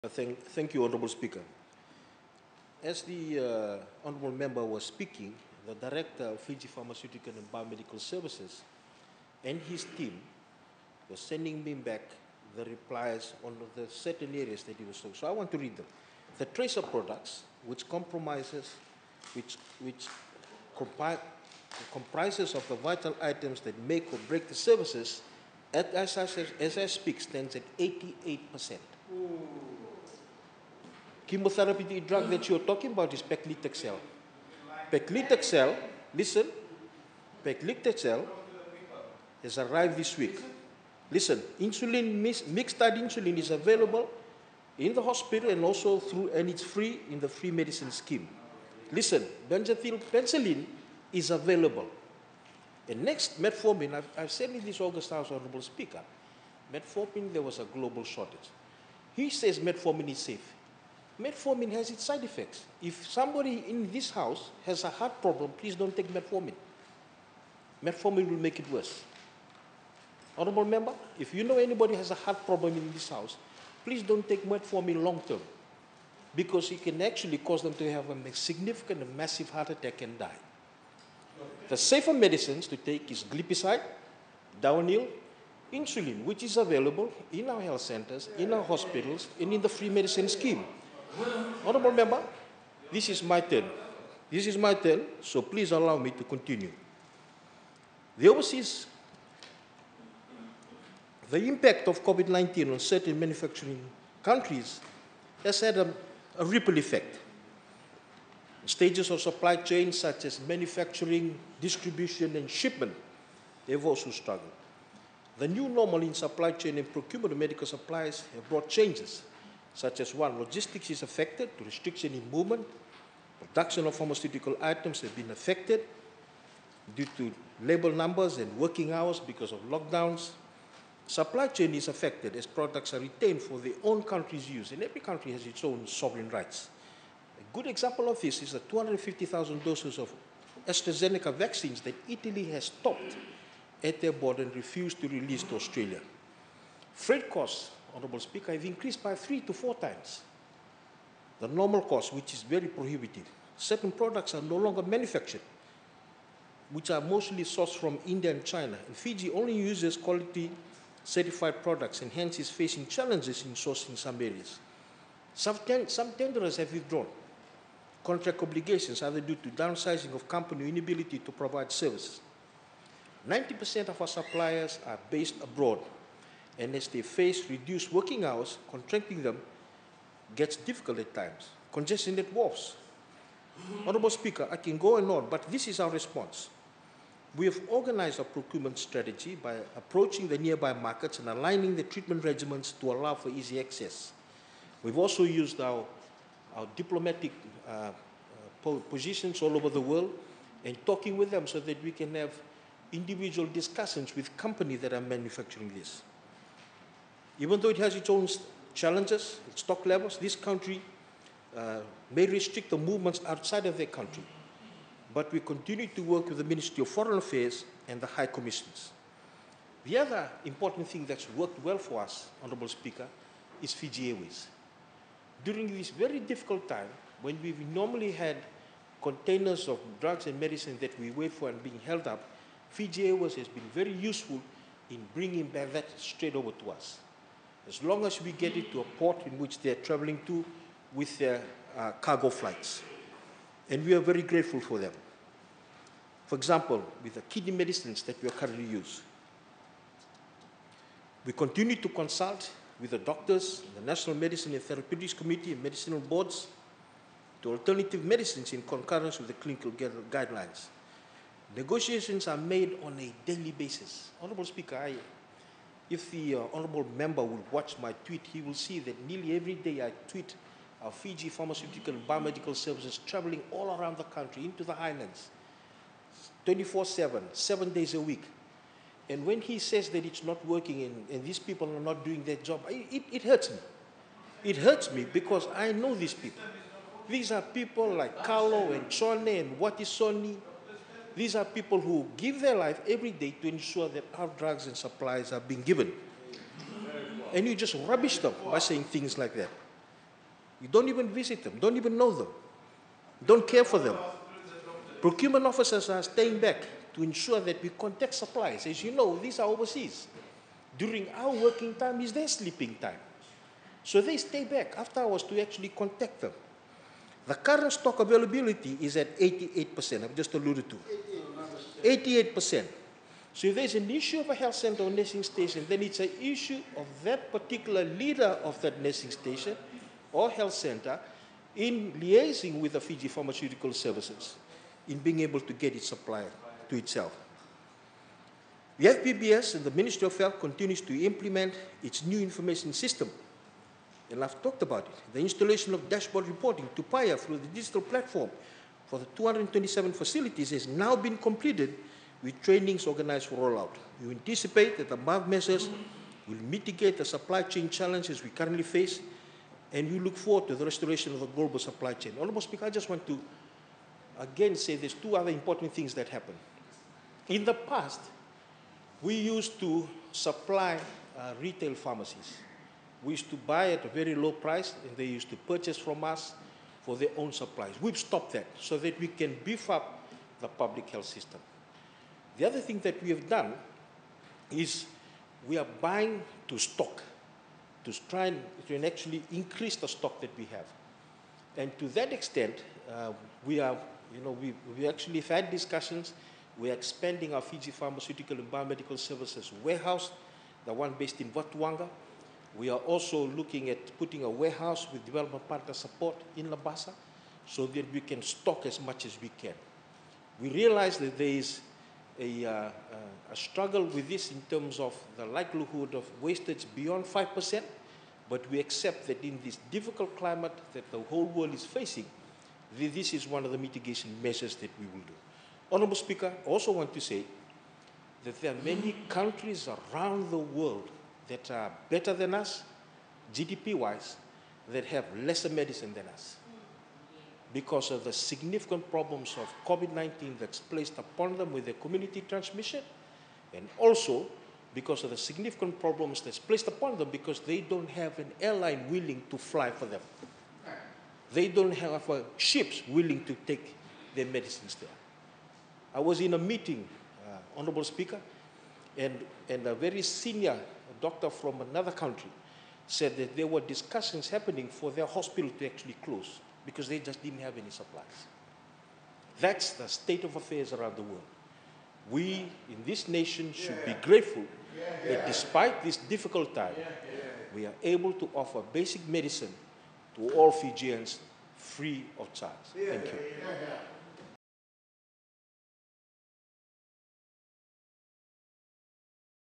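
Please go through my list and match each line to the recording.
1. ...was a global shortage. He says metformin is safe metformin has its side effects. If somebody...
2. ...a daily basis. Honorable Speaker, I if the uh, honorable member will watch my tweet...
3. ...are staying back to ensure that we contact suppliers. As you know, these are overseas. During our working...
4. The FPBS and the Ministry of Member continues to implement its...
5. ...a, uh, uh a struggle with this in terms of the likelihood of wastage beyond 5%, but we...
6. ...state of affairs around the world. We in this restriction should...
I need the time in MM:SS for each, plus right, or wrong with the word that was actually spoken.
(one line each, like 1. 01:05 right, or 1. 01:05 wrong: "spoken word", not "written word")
1. 00:57 right
2. 04:22 right
3. 05:05 right
4. 05:38 wrong: "Health", not "Member"
5. 06:52 right
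6. 07:49 wrong: "nation", not "restriction".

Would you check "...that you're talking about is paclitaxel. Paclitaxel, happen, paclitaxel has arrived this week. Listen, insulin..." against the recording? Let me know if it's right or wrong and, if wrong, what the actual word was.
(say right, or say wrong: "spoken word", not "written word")
wrong: "listen", not "happen".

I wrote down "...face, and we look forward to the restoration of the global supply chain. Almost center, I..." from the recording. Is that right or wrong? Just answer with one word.
wrong.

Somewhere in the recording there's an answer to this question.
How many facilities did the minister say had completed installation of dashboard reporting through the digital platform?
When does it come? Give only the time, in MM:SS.
05:49.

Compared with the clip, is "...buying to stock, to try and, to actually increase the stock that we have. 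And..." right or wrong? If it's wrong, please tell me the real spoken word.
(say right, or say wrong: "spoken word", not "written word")
right.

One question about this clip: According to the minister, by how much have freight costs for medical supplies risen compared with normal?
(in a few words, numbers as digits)
Three to four times.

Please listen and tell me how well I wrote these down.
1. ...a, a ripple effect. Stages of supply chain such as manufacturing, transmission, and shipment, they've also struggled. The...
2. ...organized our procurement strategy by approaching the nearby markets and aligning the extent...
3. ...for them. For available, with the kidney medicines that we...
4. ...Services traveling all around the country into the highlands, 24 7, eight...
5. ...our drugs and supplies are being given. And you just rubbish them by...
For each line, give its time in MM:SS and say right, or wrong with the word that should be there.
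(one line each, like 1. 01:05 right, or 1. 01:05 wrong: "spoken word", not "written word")
1. 01:45 wrong: "distribution", not "transmission"
2. 03:07 wrong: "treatment", not "extent"
3. 04:04 wrong: "example", not "available"
4. 04:32 wrong: "seven", not "eight"
5. 04:54 right.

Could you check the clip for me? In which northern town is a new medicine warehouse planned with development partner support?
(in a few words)
Labasa.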